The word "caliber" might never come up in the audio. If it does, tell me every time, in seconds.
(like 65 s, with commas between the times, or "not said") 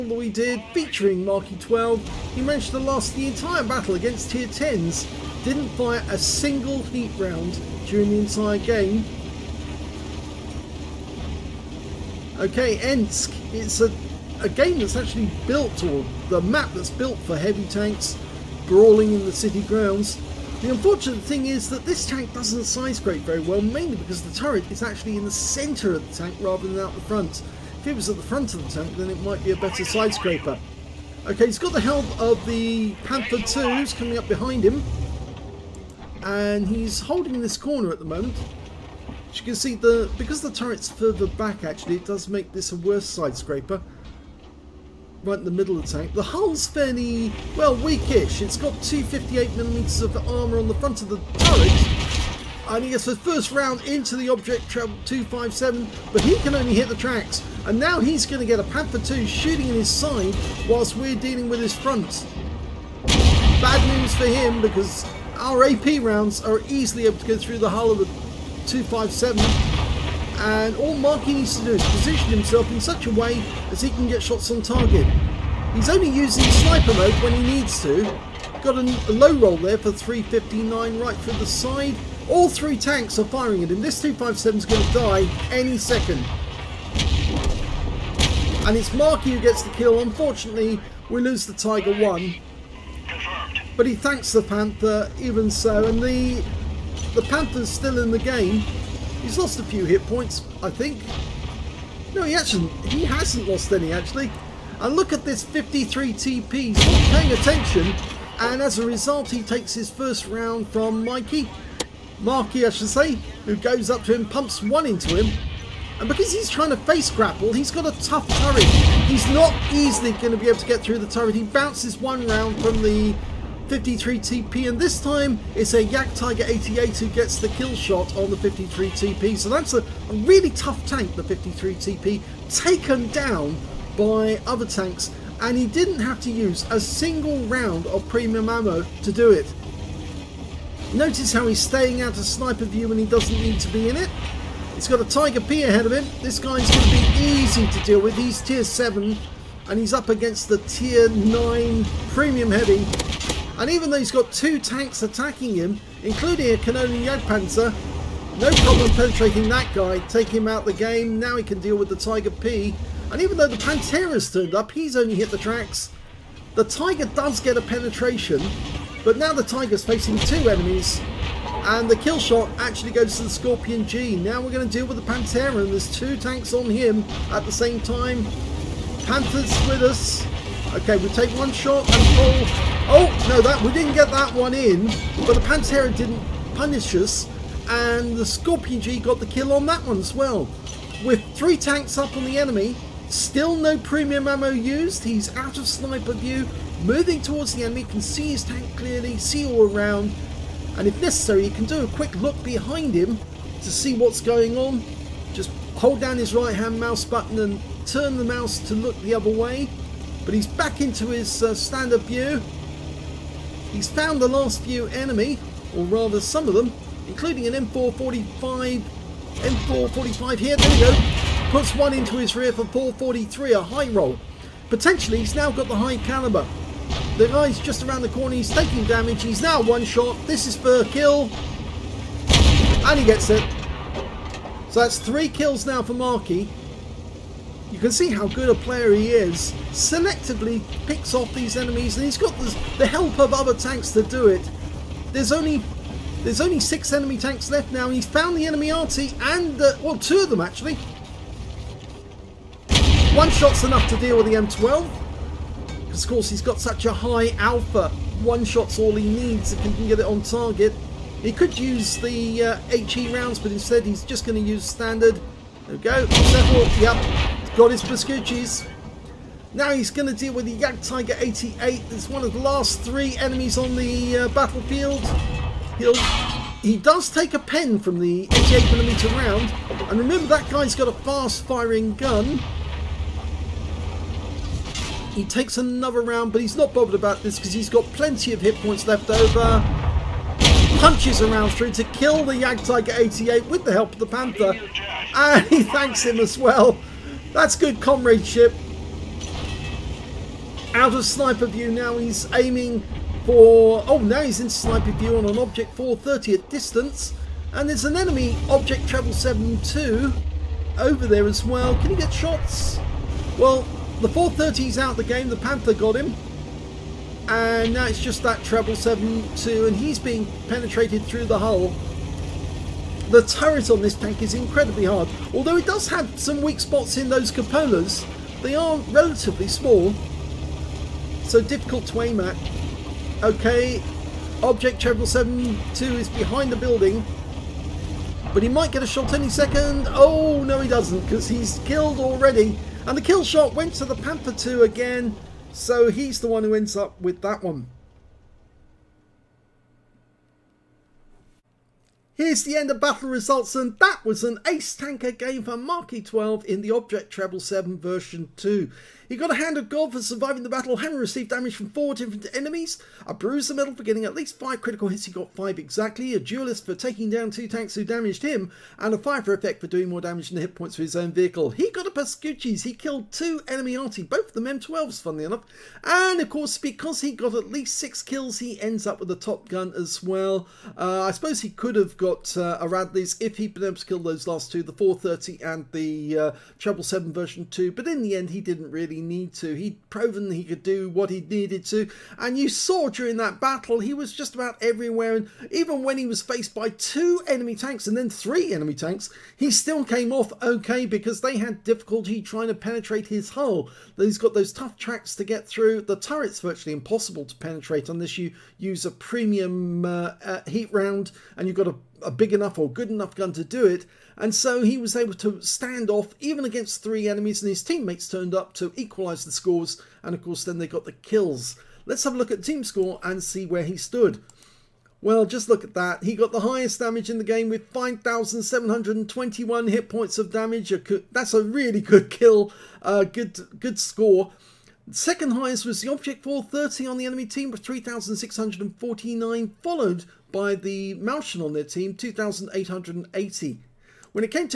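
225 s.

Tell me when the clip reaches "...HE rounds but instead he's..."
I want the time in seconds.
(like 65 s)
262 s.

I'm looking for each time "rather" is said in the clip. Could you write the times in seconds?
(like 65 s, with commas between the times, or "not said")
26 s, 215 s.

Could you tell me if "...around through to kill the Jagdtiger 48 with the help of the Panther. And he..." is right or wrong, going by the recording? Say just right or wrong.
wrong.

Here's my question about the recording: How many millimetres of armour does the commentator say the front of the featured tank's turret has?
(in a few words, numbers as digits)
258.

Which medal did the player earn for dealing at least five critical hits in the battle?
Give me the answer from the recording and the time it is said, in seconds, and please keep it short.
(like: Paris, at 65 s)
Bruiser, at 363 s.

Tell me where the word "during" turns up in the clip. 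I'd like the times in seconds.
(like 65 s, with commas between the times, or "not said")
7 s, 392 s.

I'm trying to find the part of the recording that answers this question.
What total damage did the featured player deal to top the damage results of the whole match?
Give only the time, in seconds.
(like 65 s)
427 s.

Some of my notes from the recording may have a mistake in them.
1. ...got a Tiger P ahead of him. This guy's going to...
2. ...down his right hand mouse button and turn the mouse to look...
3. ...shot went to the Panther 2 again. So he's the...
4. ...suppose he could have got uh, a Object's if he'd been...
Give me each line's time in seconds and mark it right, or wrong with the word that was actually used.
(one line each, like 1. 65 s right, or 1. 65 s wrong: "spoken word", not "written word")
1. 144 s right
2. 205 s right
3. 343 s right
4. 381 s wrong: "Radley", not "Object".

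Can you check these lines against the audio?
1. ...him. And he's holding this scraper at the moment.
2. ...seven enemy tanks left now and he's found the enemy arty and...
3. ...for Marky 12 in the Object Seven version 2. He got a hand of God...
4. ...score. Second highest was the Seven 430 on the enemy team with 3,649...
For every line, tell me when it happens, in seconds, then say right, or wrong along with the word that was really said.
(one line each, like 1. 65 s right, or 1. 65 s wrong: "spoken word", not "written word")
1. 34 s wrong: "corner", not "scraper"
2. 246 s wrong: "six", not "seven"
3. 355 s right
4. 433 s wrong: "Object", not "Seven".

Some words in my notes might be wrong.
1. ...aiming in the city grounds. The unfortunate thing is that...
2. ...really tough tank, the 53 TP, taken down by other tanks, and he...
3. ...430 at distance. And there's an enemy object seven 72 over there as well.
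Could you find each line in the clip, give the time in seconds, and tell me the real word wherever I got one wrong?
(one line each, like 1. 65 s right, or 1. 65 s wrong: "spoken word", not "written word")
1. 18 s wrong: "brawling", not "aiming"
2. 130 s right
3. 305 s right.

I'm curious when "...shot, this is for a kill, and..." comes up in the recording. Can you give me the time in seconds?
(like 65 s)
229 s.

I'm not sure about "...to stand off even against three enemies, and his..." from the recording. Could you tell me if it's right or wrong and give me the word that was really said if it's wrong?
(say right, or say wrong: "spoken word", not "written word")
right.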